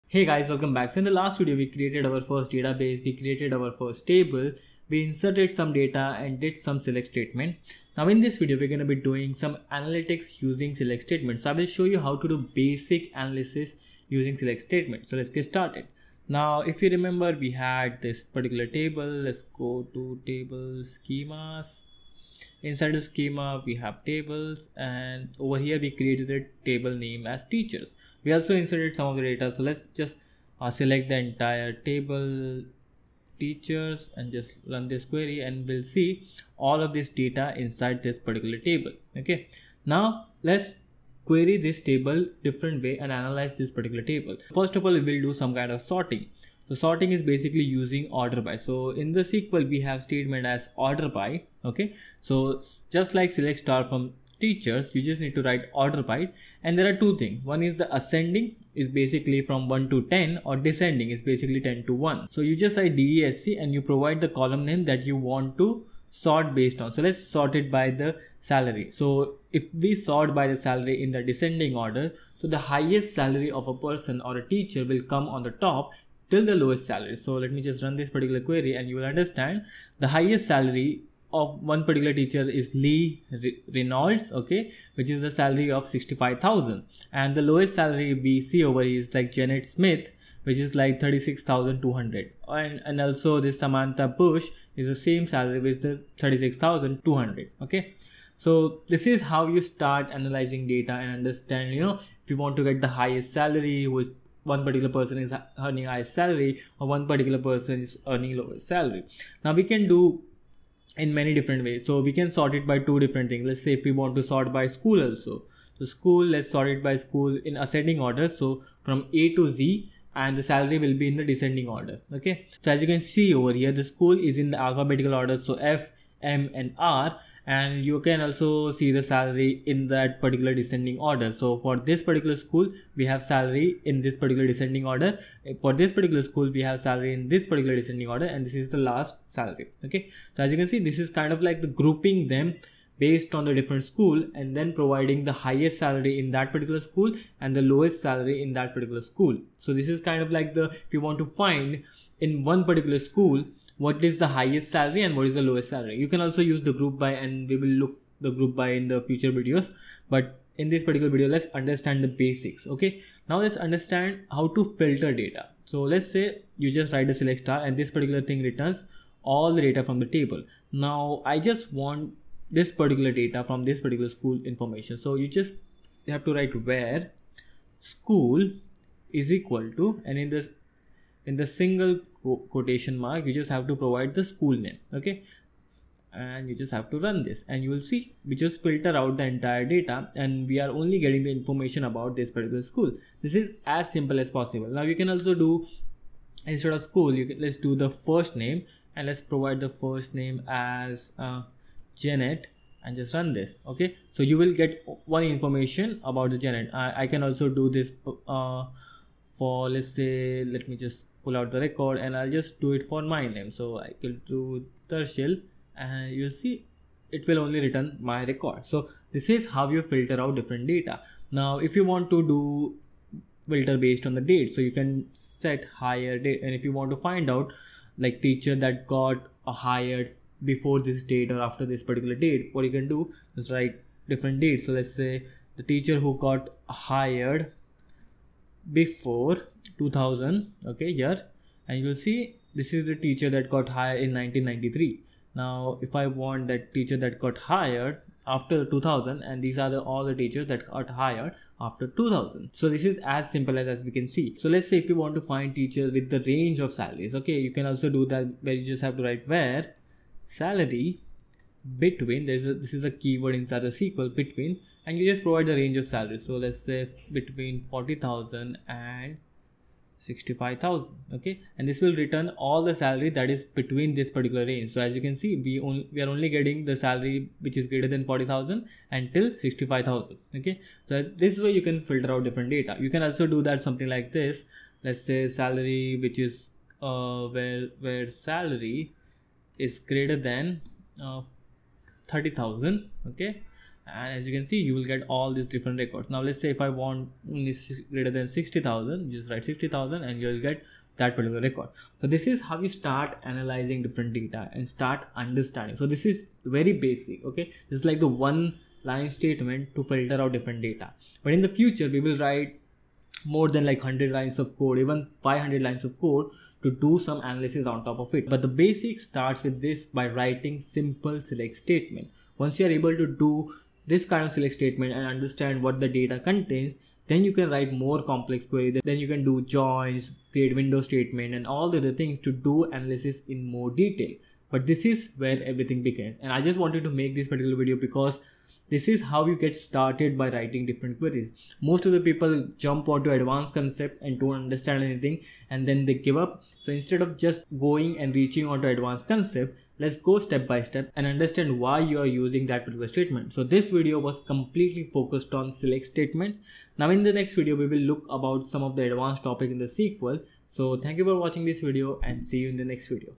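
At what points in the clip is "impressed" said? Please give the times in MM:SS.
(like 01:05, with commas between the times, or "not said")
not said.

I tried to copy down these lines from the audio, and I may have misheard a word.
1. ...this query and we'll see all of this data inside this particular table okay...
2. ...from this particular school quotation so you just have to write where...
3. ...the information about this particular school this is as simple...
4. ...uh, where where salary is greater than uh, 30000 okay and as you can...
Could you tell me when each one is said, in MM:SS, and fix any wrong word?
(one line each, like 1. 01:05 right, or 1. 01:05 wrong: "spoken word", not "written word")
1. 00:34 right
2. 02:53 wrong: "information", not "quotation"
3. 03:11 right
4. 04:46 right.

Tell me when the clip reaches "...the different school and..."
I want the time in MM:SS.
02:23.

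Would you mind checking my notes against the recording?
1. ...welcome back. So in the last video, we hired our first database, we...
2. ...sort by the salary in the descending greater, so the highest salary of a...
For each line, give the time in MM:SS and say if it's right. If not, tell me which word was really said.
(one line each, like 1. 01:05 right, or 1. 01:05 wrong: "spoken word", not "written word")
1. 00:00 wrong: "created", not "hired"
2. 01:09 wrong: "order", not "greater".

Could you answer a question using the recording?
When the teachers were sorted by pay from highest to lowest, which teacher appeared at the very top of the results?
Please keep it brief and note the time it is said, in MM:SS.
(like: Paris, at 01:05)
Lee Reynolds, at 01:22.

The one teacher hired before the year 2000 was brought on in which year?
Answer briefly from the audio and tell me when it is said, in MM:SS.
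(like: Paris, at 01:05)
1993, at 04:04.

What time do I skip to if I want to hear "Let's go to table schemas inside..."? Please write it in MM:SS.
00:19.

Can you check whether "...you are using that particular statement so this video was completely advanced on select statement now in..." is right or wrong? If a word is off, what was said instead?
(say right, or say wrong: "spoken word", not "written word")
wrong: "focused", not "advanced".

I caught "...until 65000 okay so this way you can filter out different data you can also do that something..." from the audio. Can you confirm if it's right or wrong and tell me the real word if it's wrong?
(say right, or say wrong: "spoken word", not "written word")
right.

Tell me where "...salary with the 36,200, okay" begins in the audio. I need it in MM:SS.
01:35.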